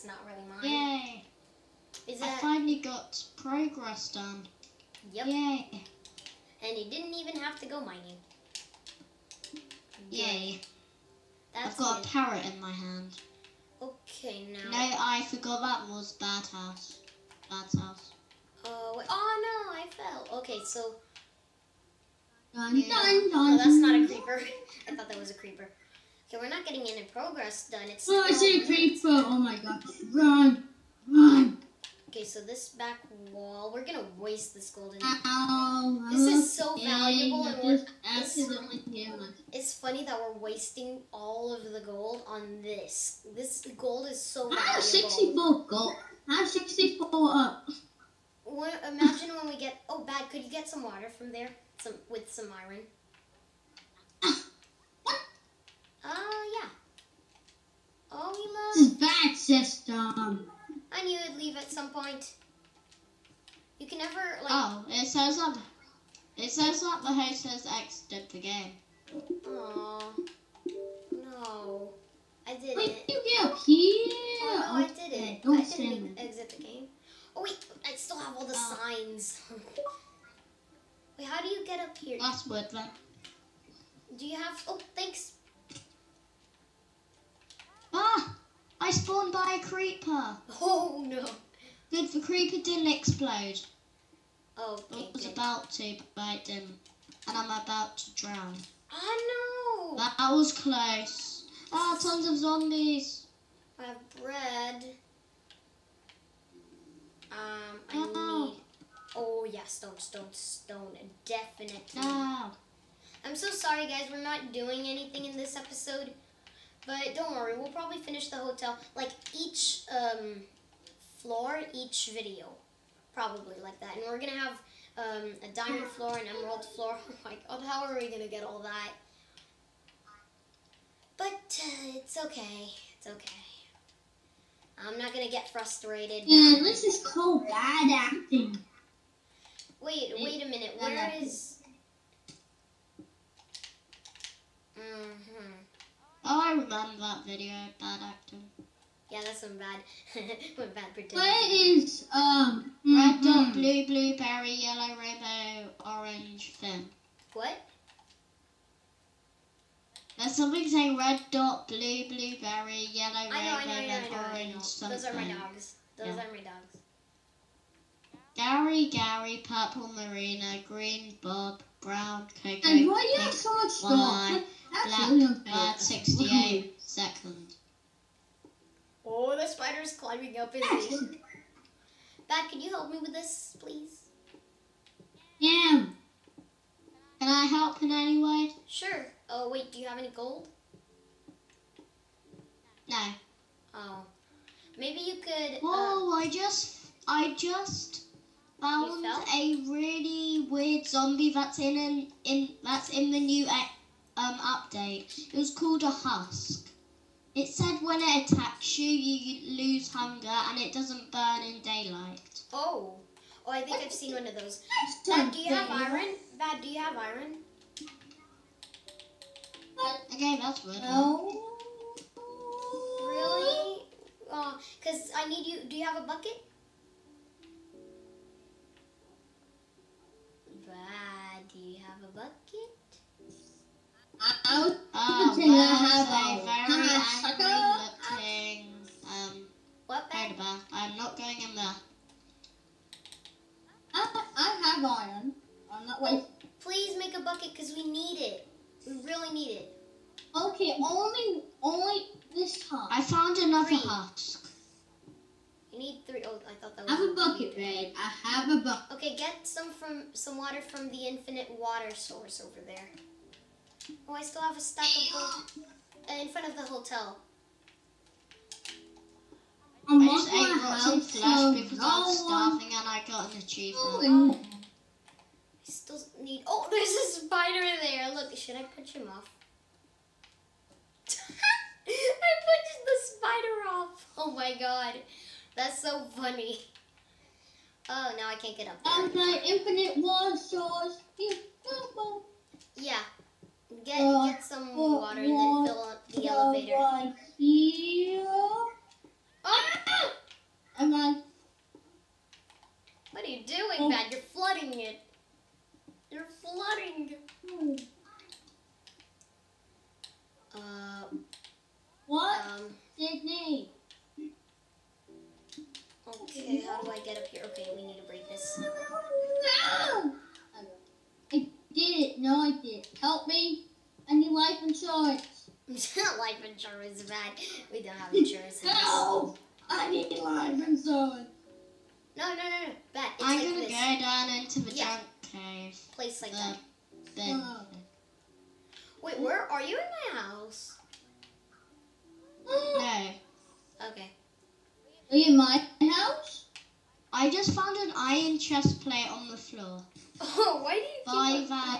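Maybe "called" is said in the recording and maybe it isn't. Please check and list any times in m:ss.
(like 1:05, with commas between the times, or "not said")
2:17, 3:25.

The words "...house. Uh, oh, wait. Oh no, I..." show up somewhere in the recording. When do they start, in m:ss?
0:17.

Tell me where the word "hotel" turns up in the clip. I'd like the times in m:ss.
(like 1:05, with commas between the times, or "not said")
1:58, 4:26.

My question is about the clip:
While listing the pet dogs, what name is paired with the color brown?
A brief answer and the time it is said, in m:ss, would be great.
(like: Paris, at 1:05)
Coconut, at 2:52.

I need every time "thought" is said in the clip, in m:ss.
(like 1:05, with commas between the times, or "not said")
0:24, 4:16.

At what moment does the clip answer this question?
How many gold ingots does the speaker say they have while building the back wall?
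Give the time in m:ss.
0:44.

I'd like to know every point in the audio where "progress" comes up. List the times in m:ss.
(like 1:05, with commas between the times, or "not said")
0:03, 0:27.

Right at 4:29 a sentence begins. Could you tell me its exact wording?
i just ate rotten flesh because I was starving and I got an achievement.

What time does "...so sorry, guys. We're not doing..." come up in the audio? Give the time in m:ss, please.
1:53.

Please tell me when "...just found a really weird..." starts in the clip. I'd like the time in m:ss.
3:17.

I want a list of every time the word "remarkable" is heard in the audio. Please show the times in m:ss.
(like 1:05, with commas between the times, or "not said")
not said.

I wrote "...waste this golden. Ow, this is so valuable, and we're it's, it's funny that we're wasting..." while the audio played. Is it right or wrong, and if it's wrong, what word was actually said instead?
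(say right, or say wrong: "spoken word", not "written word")
right.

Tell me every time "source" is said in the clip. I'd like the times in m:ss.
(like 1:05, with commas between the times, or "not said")
4:21, 4:50.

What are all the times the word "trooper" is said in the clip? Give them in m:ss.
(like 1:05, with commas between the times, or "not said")
not said.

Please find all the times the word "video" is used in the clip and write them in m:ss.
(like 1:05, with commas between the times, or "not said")
2:02, 2:27.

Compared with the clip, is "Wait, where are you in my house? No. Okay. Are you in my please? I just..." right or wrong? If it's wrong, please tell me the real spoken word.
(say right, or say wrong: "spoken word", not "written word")
wrong: "house", not "please".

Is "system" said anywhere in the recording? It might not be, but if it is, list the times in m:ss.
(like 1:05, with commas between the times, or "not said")
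0:59.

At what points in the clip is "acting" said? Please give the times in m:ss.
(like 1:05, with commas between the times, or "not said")
2:17, 2:28.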